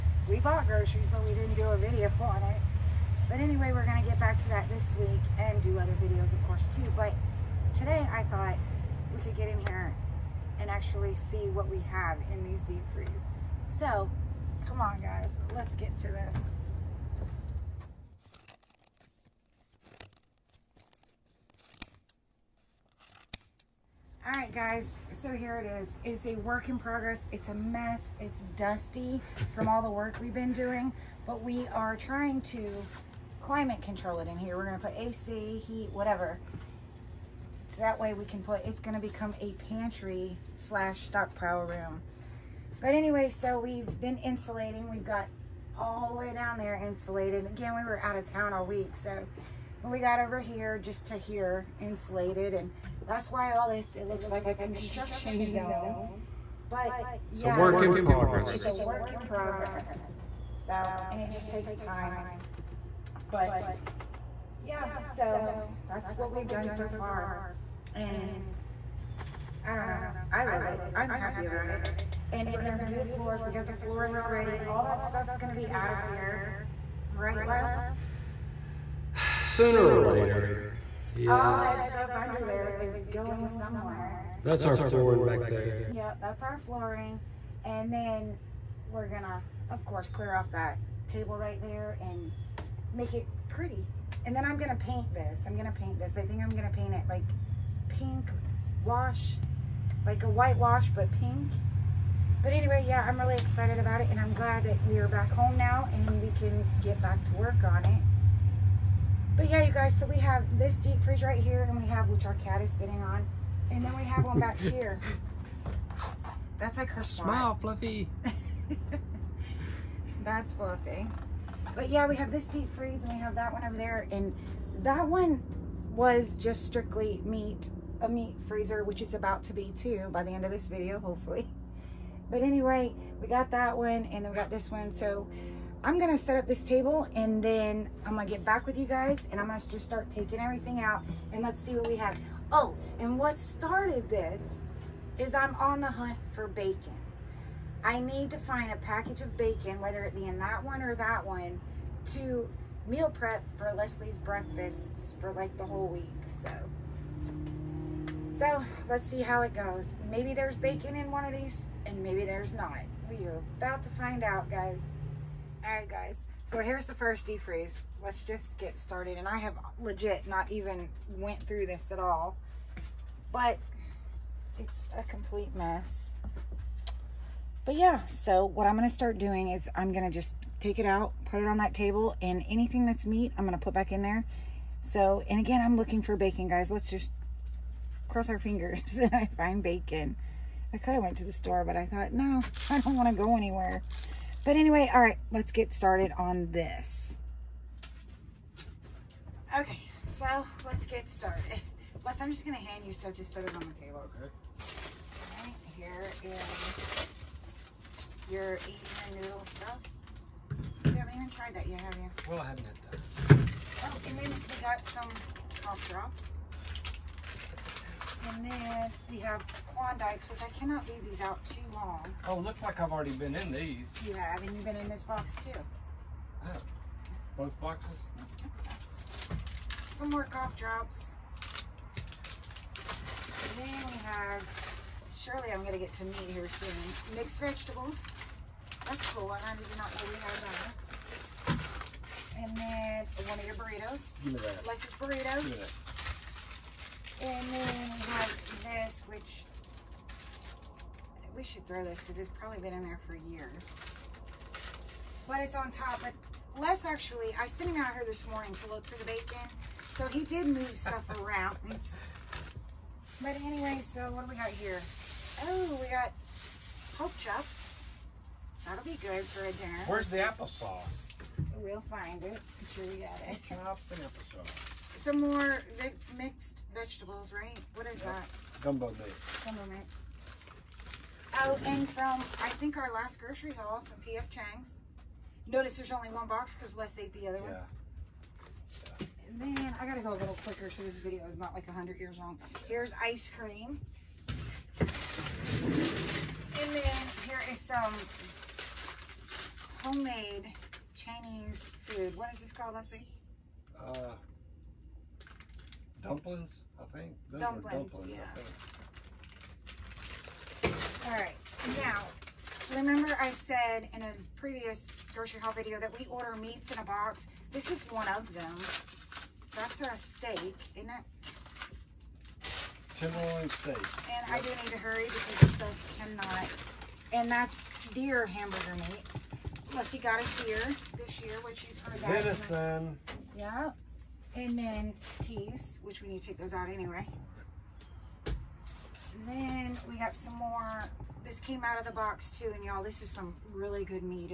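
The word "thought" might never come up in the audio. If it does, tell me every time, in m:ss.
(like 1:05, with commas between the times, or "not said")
0:08, 3:11.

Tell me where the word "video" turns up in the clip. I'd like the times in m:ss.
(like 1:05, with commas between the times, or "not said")
0:01, 0:06, 2:10, 4:50, 5:15.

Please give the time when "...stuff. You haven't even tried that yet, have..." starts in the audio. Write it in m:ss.
3:29.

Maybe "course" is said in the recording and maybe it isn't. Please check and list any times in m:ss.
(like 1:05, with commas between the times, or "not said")
0:06, 1:29.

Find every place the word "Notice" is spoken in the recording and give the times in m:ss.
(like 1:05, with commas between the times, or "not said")
4:45.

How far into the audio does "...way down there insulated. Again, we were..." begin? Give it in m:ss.
0:46.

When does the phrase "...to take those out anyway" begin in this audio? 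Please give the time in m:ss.
5:36.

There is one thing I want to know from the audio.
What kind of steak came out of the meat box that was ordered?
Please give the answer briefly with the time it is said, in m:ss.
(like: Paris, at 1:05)
Tenderloin steak, at 5:22.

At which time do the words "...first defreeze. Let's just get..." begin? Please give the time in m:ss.
2:46.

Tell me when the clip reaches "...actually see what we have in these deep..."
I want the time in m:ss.
0:10.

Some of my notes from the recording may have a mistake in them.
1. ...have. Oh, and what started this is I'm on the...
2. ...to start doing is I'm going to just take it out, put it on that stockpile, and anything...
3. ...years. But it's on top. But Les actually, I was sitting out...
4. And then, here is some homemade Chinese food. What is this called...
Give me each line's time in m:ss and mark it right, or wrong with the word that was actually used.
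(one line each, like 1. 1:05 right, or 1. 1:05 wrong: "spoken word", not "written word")
1. 2:21 right
2. 2:58 wrong: "table", not "stockpile"
3. 4:13 right
4. 4:54 right.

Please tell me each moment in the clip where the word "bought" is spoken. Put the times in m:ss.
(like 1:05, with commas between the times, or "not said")
0:00.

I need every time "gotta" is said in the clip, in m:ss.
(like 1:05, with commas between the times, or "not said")
4:49.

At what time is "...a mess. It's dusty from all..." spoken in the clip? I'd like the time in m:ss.
0:27.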